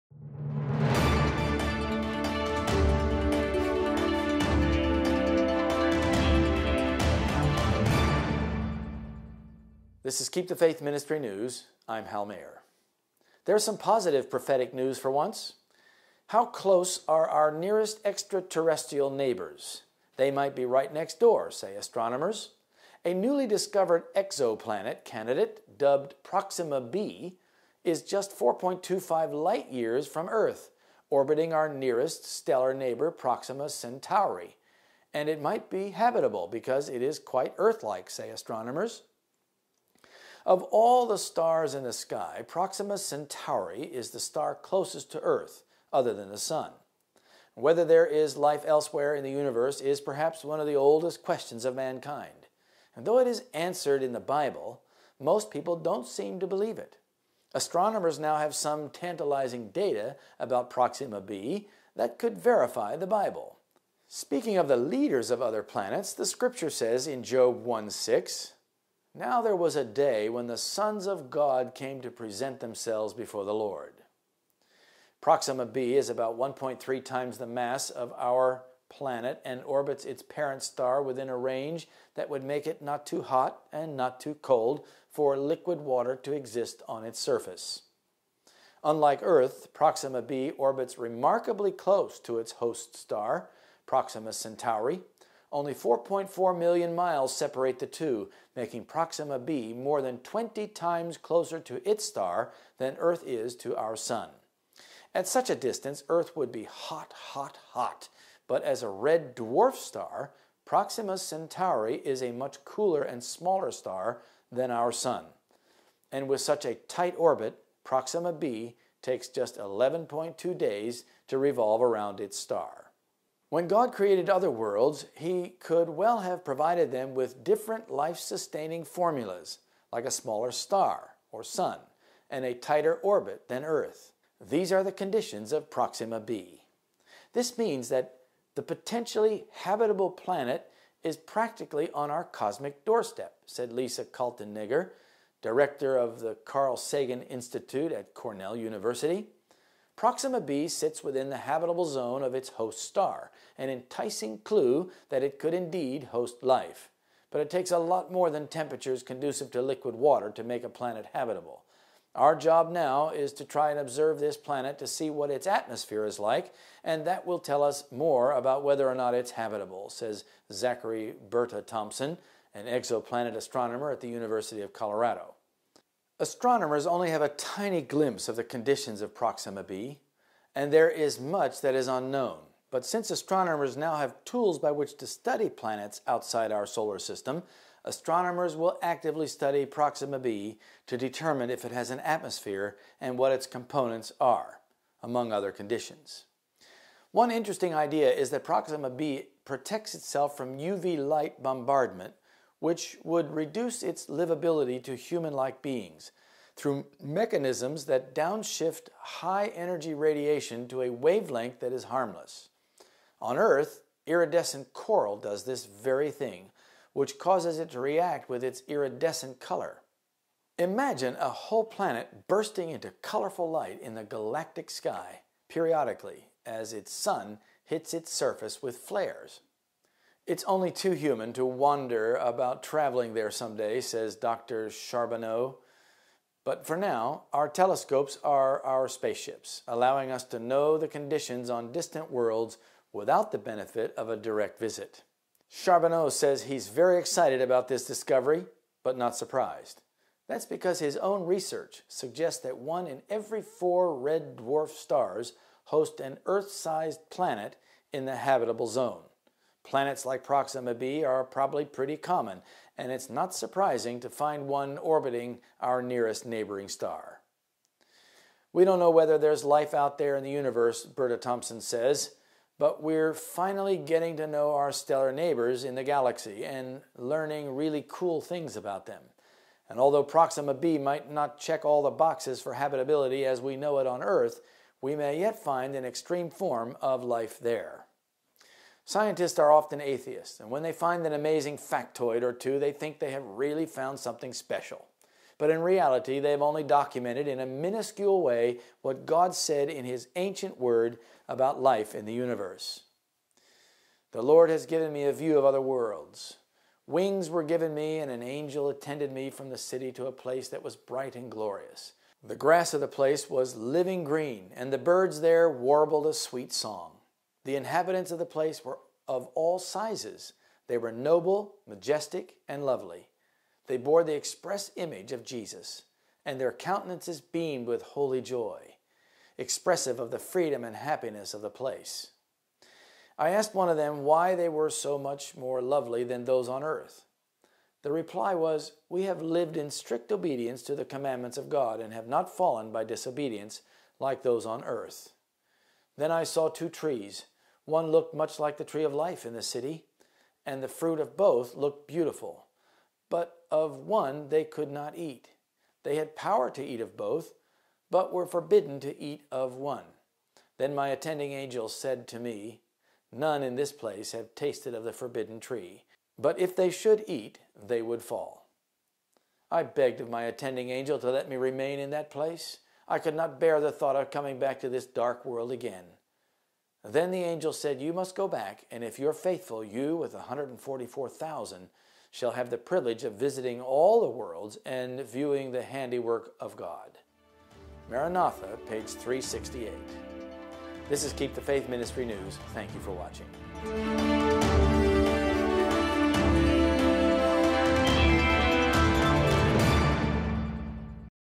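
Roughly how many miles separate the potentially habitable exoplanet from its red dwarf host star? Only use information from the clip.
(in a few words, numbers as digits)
4.4 million miles.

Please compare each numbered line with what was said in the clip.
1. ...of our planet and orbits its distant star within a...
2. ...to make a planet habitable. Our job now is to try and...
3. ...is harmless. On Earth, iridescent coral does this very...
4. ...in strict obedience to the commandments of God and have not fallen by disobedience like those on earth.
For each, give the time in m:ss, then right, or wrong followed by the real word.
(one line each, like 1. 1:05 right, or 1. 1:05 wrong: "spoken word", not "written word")
1. 1:17 wrong: "parent", not "distant"
2. 2:40 right
3. 3:31 right
4. 5:39 right.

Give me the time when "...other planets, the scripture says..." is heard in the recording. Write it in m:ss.
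1:05.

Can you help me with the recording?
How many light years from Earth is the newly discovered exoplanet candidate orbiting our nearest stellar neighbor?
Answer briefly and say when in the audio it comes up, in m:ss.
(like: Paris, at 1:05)
4.25, at 0:28.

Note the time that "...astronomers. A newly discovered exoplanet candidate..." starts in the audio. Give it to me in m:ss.
0:21.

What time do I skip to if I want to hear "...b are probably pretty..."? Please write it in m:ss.
4:20.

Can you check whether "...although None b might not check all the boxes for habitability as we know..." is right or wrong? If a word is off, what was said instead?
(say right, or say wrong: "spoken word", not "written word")
wrong: "Proxima", not "None".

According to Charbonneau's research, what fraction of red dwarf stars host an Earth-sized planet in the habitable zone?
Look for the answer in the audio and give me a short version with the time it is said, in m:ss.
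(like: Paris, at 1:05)
1 in 4, at 4:12.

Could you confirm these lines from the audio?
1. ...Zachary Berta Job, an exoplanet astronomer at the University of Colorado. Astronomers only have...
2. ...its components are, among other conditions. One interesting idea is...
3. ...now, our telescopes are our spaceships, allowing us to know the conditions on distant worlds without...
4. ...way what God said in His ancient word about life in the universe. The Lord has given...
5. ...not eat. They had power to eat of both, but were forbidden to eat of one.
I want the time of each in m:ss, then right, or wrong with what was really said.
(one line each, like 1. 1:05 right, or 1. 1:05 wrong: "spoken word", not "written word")
1. 2:50 wrong: "Thompson", not "Job"
2. 3:13 right
3. 3:56 right
4. 4:58 right
5. 5:54 right.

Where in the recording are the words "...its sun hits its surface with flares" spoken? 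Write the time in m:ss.
3:46.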